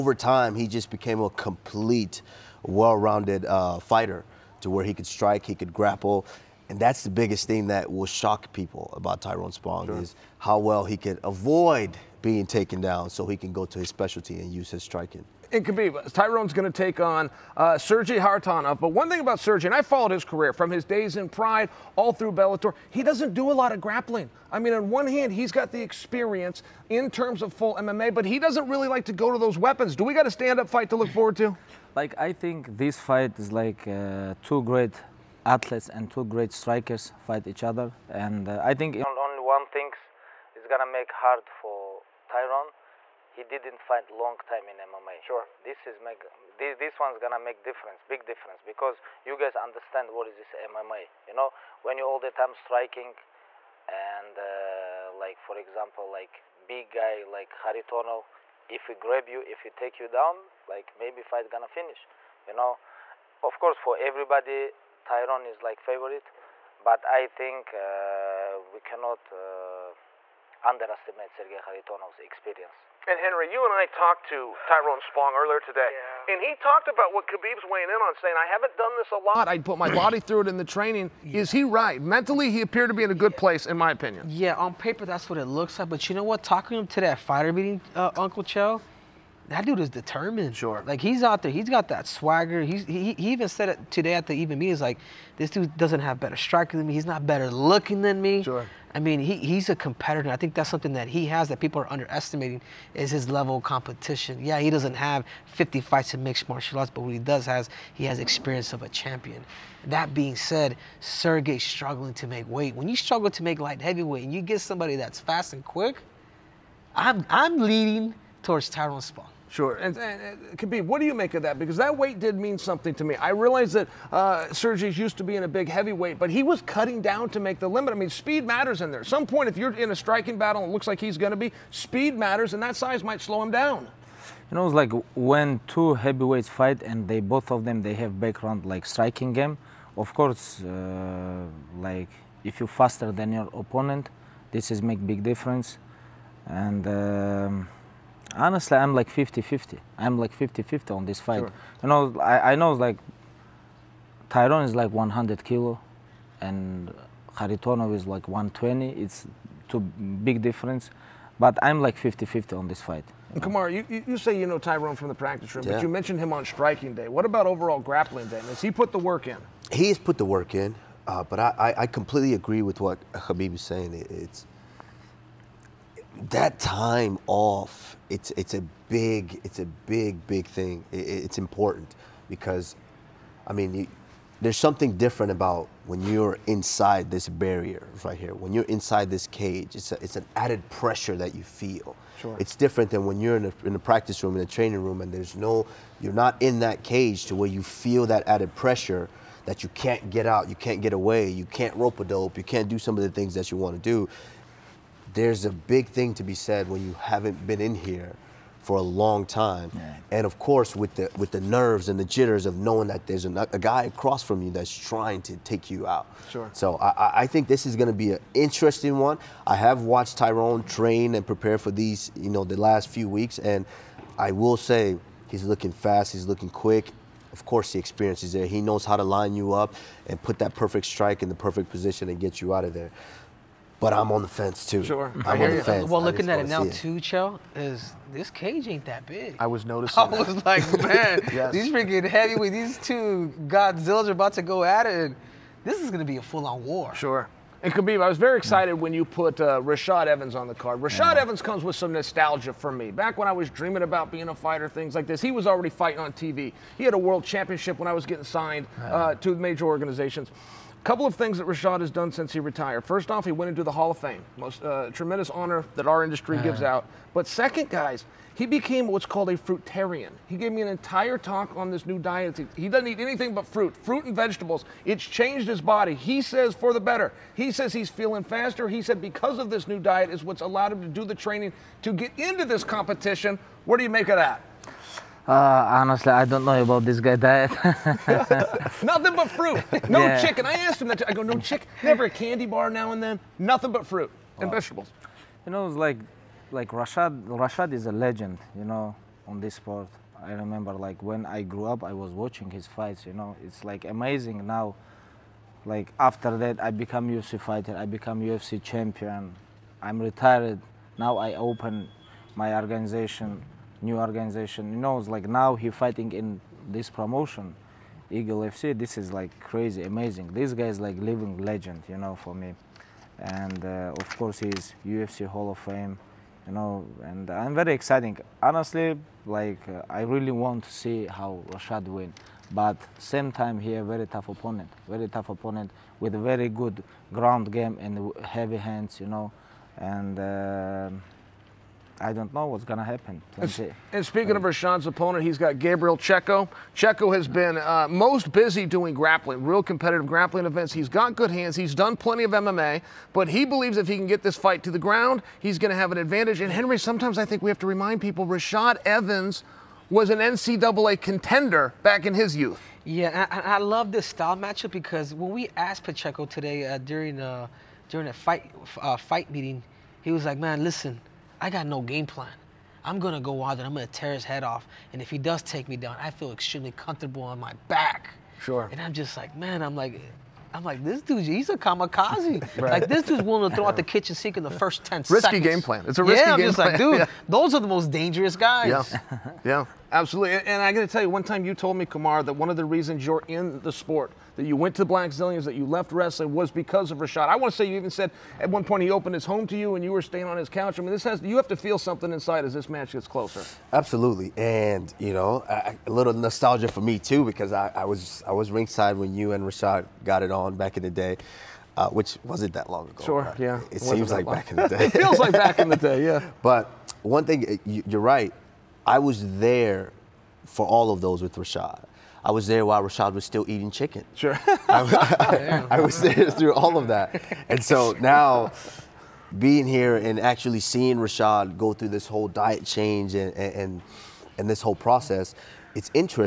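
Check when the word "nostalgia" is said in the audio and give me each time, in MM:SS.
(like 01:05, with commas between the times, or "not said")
04:11, 06:46.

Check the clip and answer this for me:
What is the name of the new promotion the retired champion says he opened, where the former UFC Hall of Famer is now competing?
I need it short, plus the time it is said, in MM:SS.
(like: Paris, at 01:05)
Eagle FC, at 05:18.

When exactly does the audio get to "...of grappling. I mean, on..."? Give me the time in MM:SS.
00:23.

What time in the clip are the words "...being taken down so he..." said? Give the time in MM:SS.
00:12.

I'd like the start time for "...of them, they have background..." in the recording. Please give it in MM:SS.
02:17.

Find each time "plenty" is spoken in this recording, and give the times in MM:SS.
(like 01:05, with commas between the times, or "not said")
05:51.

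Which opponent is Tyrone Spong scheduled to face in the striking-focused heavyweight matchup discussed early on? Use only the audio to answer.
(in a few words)
Sergey Kharitonov.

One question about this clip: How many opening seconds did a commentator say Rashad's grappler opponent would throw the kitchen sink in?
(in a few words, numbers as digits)
10.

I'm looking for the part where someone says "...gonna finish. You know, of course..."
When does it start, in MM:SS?
01:01.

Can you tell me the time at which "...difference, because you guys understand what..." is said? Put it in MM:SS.
00:48.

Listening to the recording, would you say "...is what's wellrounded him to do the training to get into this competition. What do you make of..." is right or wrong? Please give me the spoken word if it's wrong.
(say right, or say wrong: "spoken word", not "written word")
wrong: "allowed", not "wellrounded".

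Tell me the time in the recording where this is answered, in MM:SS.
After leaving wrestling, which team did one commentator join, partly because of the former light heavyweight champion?
06:34.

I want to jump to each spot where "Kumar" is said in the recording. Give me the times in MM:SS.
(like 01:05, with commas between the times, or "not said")
02:43, 06:31.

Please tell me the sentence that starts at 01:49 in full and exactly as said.
That being said, Sergey struggling to make weight.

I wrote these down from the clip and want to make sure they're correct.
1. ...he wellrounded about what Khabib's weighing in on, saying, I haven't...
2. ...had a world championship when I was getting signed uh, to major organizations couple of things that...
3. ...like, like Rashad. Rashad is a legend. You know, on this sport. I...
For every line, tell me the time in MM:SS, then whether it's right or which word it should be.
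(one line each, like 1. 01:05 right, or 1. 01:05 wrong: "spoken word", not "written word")
1. 01:16 wrong: "talked", not "wellrounded"
2. 04:16 right
3. 04:55 right.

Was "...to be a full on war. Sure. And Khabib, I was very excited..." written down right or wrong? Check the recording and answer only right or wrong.
right.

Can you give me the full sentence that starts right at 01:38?
I mean, he, he's a competitor.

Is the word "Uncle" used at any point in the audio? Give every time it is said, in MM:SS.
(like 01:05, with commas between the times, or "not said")
01:28.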